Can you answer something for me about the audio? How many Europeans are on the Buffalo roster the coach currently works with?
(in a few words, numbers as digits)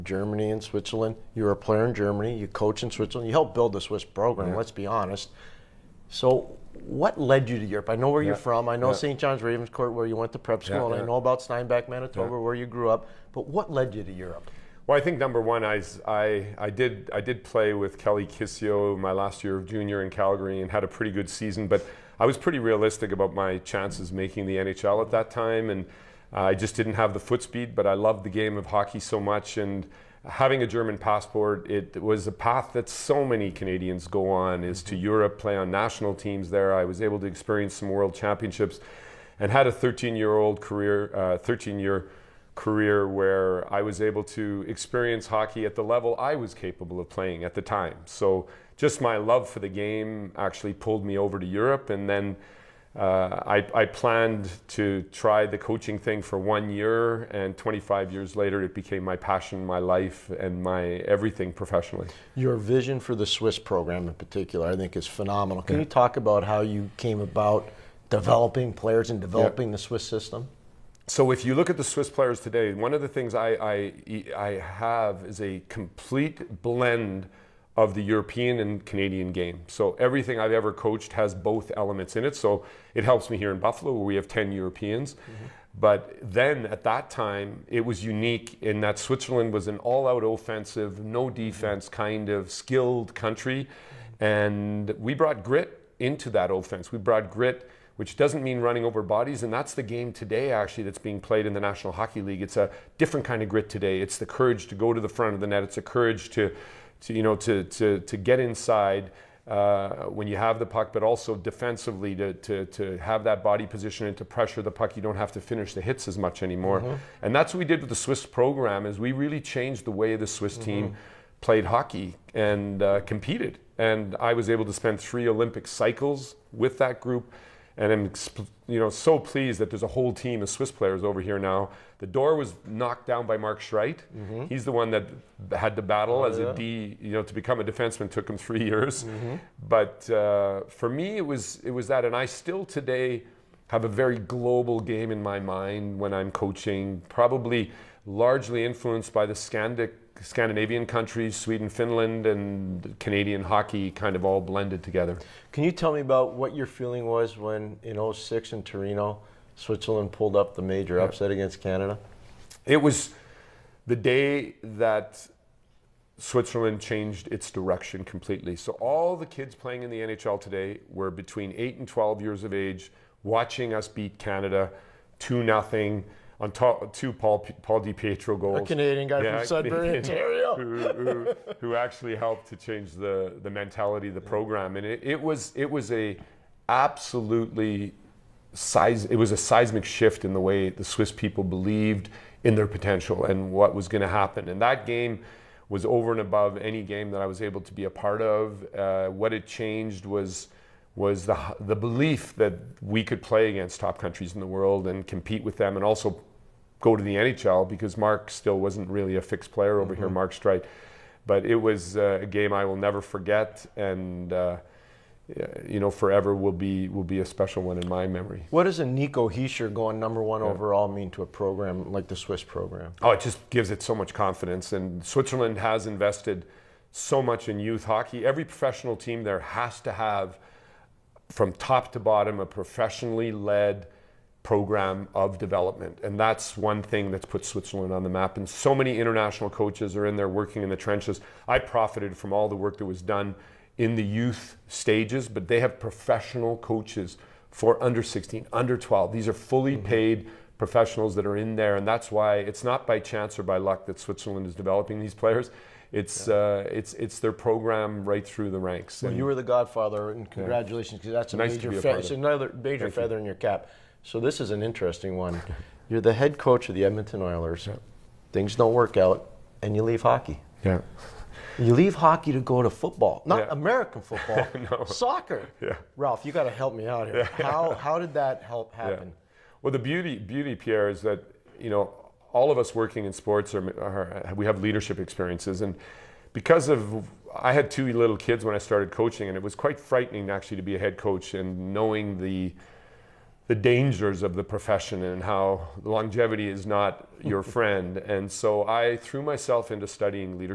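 10.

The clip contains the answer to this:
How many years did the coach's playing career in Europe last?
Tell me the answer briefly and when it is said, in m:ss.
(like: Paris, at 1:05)
13, at 0:41.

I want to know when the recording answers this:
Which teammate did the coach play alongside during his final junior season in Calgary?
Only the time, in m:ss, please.
0:17.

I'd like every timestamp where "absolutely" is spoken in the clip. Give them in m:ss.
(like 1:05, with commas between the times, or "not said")
3:06.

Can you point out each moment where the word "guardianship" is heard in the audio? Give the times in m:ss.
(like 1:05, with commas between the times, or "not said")
not said.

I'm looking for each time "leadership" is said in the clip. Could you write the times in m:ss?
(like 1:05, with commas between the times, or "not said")
4:44.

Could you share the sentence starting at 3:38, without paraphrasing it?
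What does a Nico Hischier going number one yeah.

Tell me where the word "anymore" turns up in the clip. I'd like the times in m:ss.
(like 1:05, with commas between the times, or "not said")
1:56.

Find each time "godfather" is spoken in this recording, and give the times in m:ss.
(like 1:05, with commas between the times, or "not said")
4:19.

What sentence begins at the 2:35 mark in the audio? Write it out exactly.
Can you tell me about what your feeling was when in 06 in Torino, Switzerland pulled up the major yeah.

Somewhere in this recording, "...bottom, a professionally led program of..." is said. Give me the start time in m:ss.
3:51.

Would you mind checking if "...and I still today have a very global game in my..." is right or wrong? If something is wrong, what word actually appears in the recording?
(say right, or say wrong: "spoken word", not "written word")
right.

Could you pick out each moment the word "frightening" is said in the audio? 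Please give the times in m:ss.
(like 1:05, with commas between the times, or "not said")
4:49.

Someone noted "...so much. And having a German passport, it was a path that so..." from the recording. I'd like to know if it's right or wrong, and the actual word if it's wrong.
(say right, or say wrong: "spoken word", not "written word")
right.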